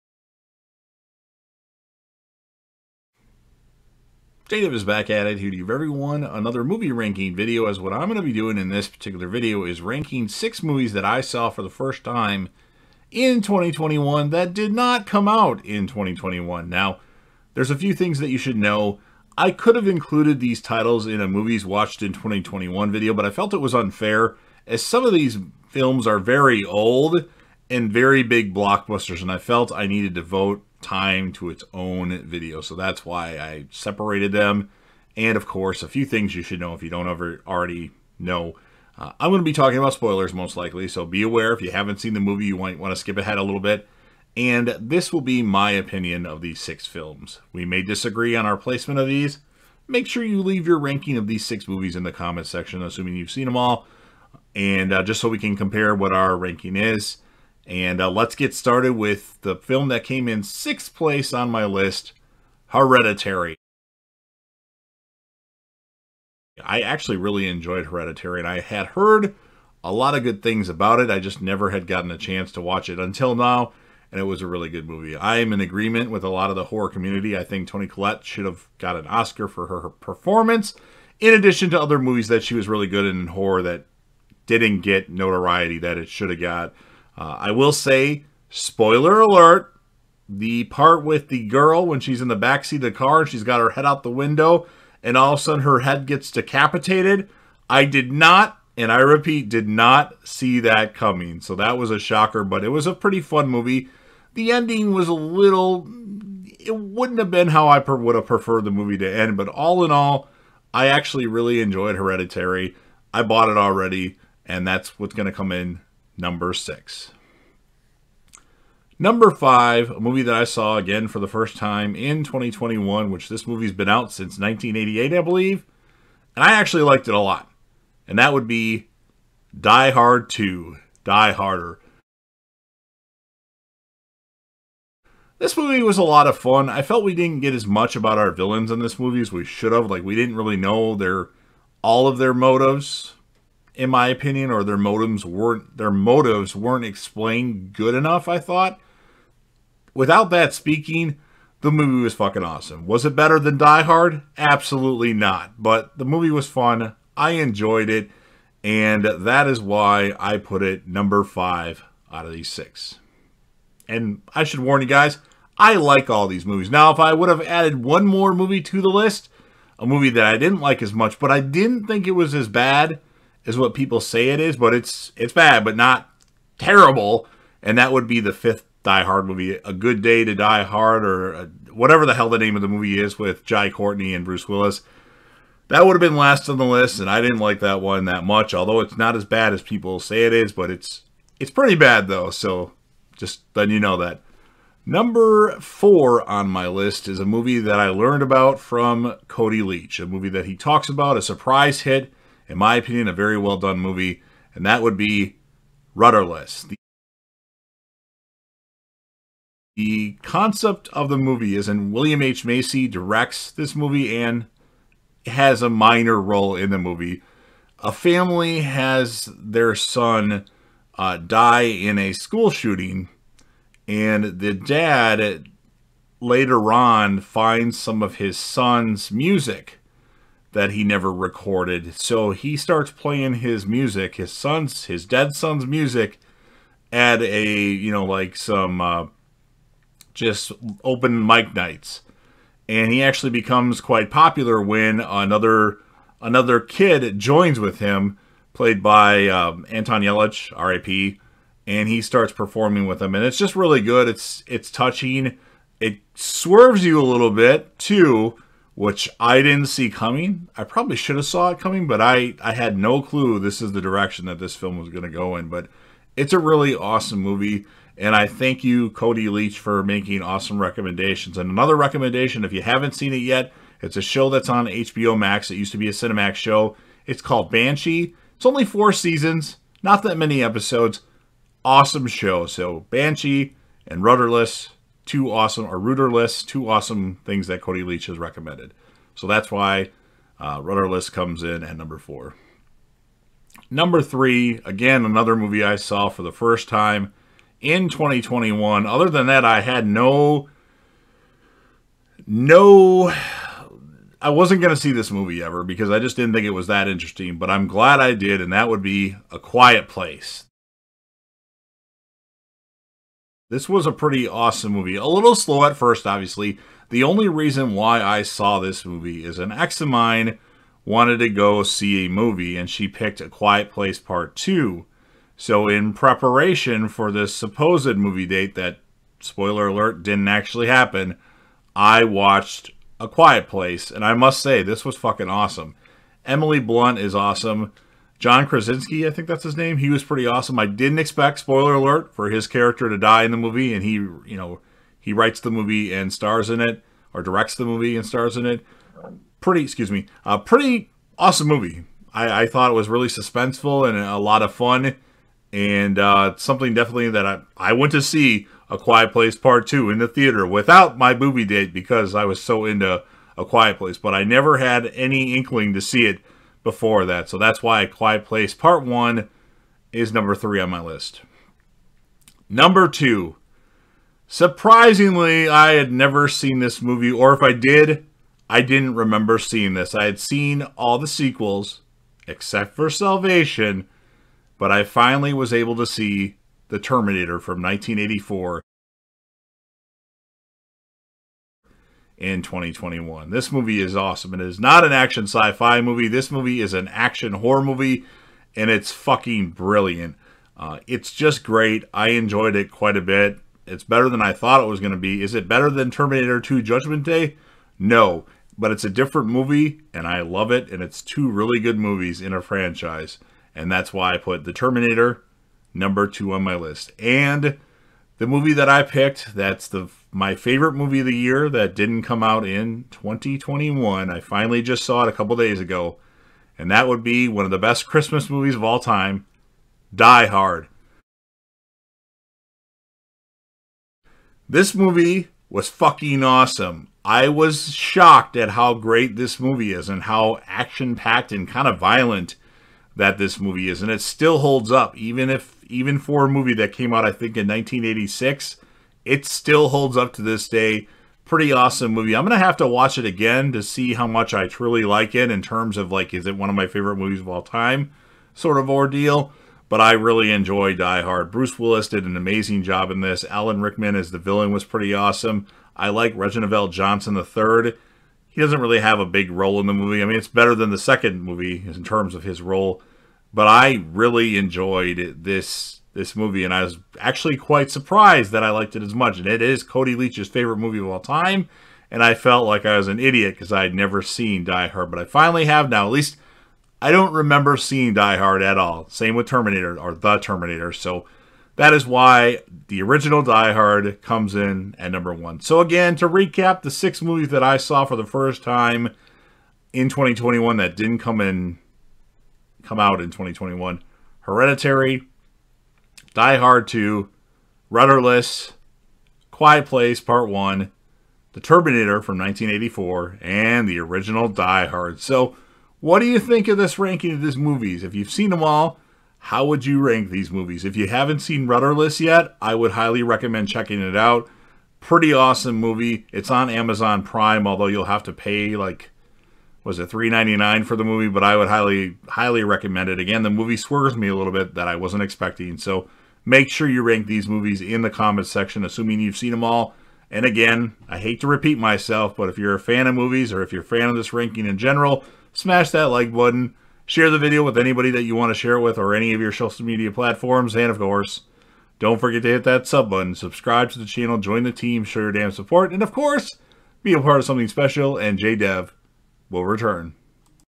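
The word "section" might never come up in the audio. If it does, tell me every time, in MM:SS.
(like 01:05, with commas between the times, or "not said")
00:52, 08:58.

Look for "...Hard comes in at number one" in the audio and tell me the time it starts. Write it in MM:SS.
08:13.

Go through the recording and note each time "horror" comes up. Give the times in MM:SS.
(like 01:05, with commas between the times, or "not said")
01:16, 01:23, 06:37.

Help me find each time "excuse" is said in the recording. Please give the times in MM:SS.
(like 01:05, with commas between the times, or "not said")
05:49.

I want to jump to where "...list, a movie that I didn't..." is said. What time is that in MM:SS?
02:48.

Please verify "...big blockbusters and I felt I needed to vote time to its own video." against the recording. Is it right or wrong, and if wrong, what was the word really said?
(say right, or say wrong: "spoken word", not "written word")
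right.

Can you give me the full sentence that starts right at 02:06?
And I actually liked it a lot.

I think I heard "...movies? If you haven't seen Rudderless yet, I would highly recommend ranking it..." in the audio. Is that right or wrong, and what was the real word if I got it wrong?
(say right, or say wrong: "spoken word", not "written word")
wrong: "checking", not "ranking".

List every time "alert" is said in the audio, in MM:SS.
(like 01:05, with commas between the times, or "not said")
01:29, 05:29, 05:41.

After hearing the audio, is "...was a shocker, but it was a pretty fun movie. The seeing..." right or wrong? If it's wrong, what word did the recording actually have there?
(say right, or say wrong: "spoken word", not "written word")
wrong: "ending", not "seeing".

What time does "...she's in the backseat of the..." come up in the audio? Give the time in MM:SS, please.
01:31.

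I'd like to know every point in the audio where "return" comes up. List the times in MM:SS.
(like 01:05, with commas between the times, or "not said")
09:19.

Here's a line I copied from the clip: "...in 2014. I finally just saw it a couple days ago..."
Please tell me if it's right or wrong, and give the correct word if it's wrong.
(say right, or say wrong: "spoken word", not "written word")
wrong: "2021", not "2014".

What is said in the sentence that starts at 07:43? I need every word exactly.
Alan Rickman as the villain was pretty awesome.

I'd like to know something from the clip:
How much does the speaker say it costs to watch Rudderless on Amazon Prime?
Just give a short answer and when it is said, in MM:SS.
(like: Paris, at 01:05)
$3.99, at 08:49.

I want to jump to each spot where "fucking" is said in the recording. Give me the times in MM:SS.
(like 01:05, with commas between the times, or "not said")
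02:32, 05:34, 06:38, 07:15.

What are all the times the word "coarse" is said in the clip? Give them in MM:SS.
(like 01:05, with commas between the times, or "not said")
not said.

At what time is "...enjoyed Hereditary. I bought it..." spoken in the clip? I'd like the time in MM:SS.
01:51.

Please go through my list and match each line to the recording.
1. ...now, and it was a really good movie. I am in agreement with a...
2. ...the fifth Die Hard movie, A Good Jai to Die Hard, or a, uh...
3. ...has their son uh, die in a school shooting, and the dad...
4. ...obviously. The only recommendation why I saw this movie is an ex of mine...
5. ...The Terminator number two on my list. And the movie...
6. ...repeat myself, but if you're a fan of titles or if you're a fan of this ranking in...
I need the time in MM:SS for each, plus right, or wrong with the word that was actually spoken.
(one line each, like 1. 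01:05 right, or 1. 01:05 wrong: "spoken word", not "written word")
1. 01:13 right
2. 02:58 wrong: "Day", not "Jai"
3. 03:38 right
4. 05:16 wrong: "reason", not "recommendation"
5. 06:54 right
6. 09:01 wrong: "movies", not "titles".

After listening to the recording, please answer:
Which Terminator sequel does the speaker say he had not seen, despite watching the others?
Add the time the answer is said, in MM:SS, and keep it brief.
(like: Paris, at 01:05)
Salvation, at 06:22.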